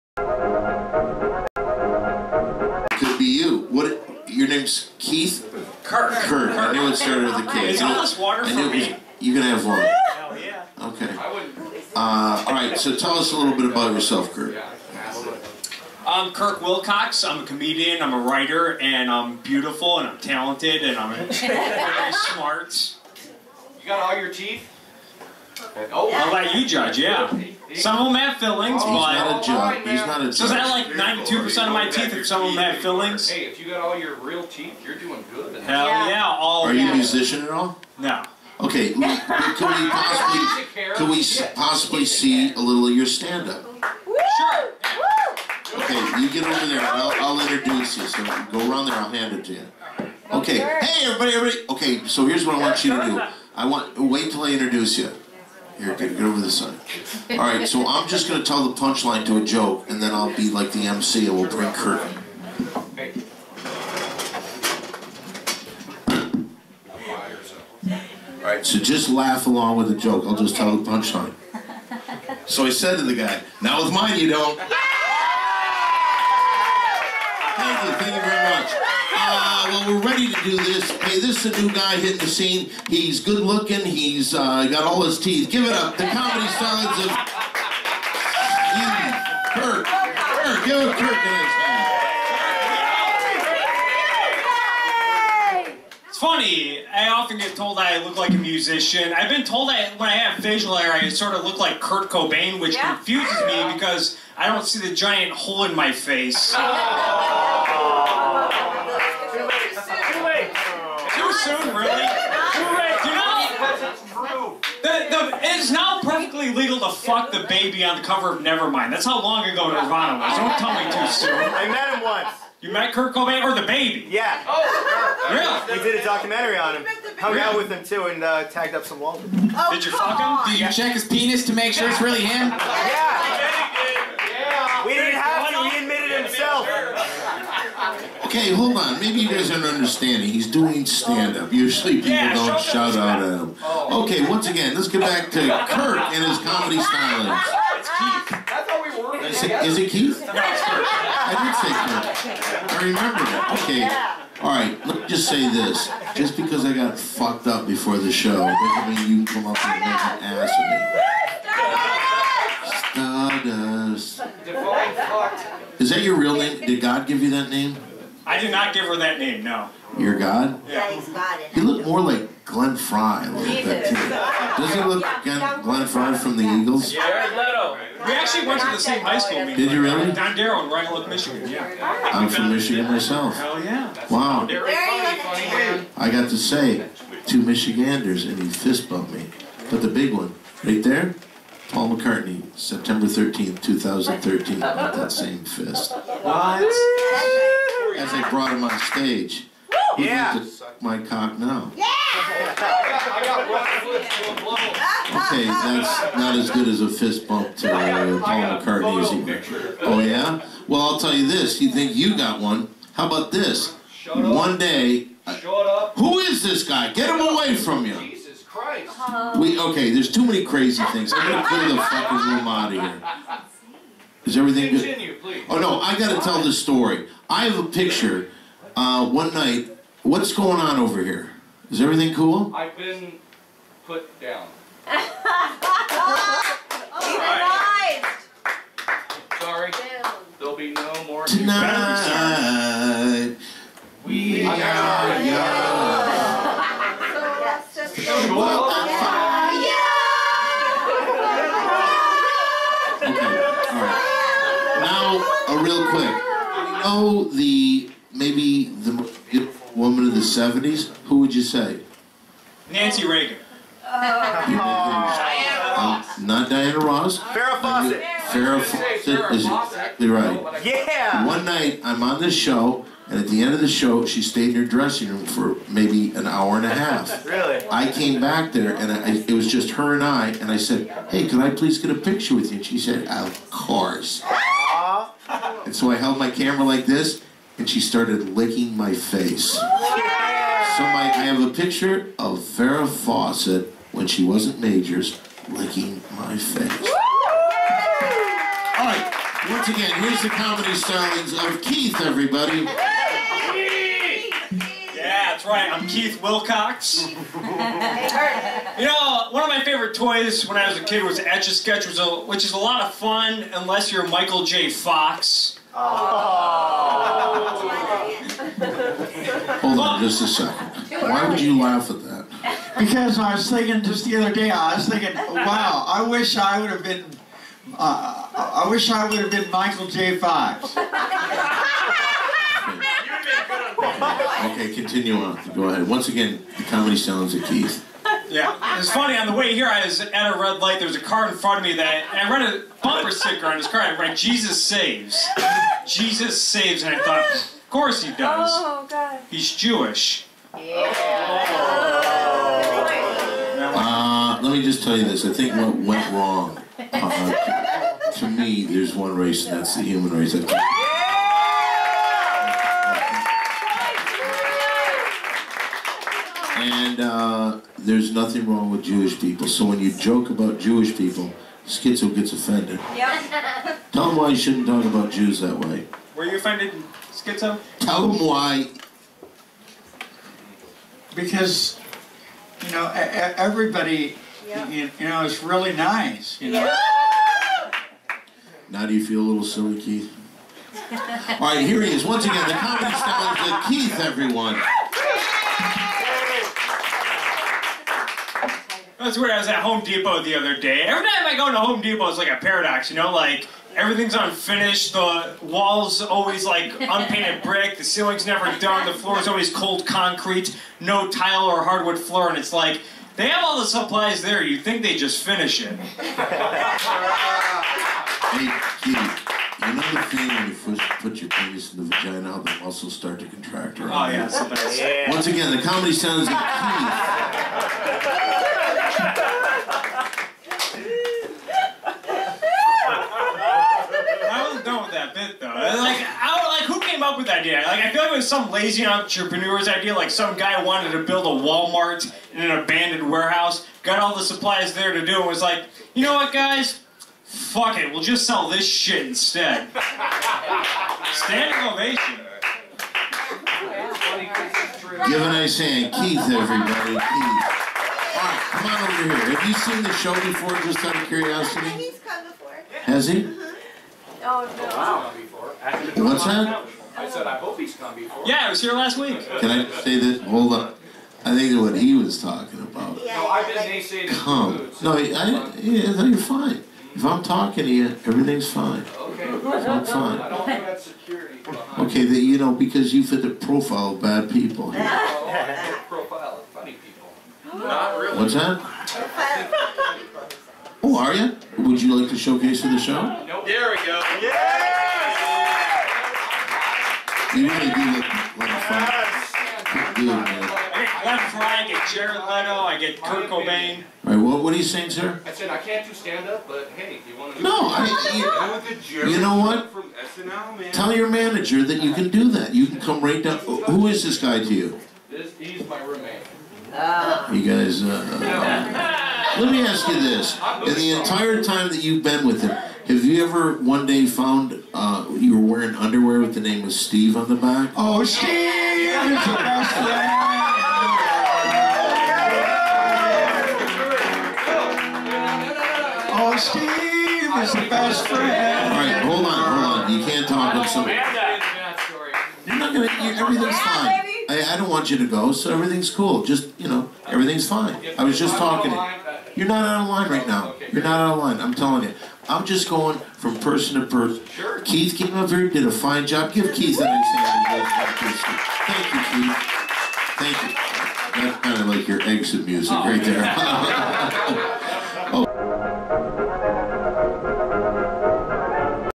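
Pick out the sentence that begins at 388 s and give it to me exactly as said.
Now do you feel a little silly, Keith?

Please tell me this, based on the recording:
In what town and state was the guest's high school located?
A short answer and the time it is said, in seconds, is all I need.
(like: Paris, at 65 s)
Royal Oak, Michigan, at 180 s.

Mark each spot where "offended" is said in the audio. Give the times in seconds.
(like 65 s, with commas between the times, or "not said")
372 s, 376 s.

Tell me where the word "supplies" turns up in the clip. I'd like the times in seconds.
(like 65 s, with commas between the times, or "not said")
413 s, 444 s.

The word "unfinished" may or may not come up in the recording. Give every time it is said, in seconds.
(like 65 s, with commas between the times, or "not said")
404 s.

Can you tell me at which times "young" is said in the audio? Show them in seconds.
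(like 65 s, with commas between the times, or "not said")
245 s.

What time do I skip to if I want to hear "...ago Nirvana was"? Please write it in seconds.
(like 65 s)
119 s.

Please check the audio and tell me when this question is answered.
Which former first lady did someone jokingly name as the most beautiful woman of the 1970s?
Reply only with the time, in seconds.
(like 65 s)
262 s.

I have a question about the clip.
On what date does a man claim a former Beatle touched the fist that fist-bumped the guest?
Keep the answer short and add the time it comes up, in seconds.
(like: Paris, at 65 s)
September 13, 2013, at 192 s.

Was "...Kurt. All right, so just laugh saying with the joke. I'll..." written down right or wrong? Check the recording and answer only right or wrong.
wrong.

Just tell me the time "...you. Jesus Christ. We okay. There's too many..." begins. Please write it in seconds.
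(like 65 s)
217 s.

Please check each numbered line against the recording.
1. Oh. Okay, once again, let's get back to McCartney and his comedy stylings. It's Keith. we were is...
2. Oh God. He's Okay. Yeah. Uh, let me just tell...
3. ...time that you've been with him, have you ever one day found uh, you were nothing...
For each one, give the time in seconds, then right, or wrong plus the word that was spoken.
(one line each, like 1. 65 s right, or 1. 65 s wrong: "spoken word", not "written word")
1. 143 s wrong: "Kirk", not "McCartney"
2. 348 s wrong: "Jewish", not "Okay"
3. 521 s wrong: "wearing", not "nothing".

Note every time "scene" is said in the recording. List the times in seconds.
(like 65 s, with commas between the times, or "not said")
82 s.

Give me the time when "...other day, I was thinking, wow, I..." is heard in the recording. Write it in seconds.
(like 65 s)
324 s.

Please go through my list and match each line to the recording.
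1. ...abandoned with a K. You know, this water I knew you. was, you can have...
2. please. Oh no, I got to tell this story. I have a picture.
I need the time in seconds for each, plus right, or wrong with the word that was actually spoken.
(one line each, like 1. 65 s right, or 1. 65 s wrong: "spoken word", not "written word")
1. 6 s wrong: "started", not "abandoned"
2. 225 s right.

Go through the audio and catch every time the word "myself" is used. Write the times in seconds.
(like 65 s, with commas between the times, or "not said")
182 s.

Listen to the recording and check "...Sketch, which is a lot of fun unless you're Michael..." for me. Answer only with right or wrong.
right.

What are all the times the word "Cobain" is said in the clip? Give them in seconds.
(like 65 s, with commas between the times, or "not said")
102 s, 123 s, 503 s.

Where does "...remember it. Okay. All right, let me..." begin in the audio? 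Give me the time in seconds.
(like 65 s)
152 s.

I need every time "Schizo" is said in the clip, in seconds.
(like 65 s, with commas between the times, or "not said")
371 s, 377 s.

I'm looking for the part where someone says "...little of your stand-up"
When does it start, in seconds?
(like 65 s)
42 s.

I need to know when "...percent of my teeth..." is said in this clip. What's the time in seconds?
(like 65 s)
31 s.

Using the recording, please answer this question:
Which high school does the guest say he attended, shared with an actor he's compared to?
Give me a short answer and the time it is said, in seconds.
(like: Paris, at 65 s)
Don Darrow, at 180 s.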